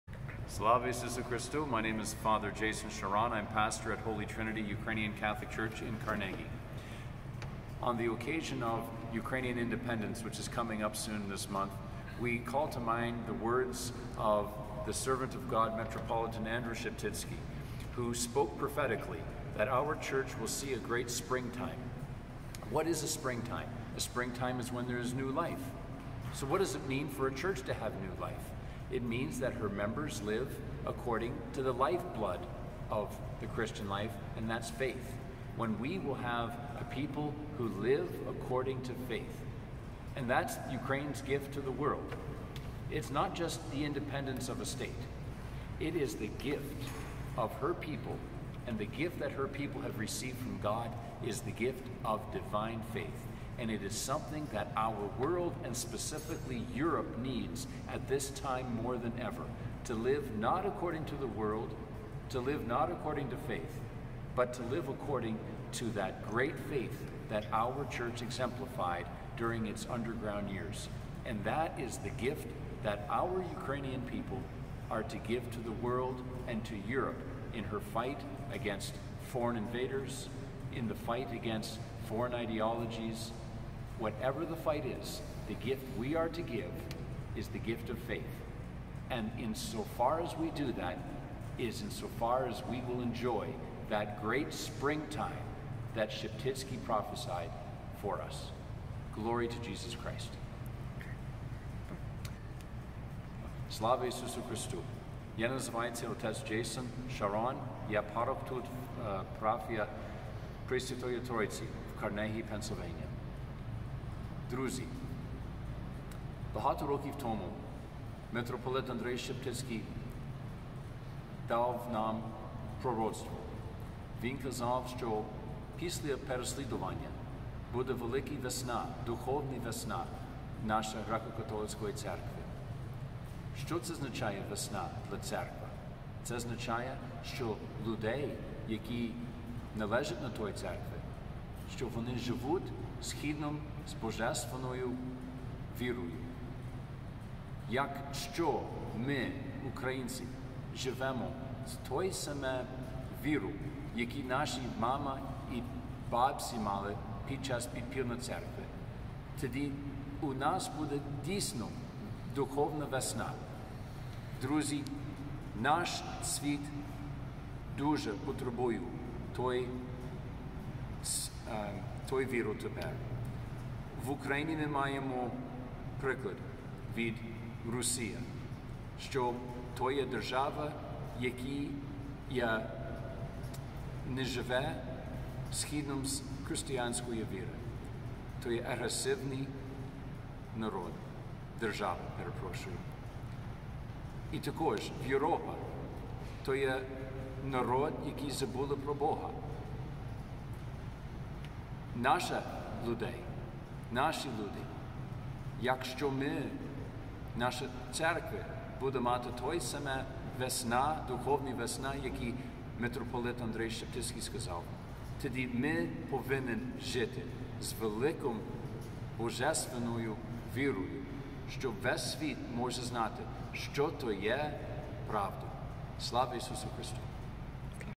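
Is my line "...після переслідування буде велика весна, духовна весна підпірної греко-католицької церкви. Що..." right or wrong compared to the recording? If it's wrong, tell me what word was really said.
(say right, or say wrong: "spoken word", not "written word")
wrong: "нашої", not "підпірної".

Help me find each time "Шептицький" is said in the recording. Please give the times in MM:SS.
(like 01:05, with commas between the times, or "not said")
01:59, 03:33.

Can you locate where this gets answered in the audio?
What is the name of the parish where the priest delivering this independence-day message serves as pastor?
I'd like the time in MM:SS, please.
00:03.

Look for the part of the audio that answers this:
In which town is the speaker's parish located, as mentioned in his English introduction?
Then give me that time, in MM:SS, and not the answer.
00:06.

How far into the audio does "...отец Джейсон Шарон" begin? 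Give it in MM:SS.
01:46.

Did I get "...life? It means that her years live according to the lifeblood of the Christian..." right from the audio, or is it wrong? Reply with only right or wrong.
wrong.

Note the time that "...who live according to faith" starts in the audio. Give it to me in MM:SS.
00:37.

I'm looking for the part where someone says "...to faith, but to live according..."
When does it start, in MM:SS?
01:03.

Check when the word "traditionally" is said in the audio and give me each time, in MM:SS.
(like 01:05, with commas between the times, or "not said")
not said.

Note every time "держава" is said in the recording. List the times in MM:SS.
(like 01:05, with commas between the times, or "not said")
03:00, 03:11.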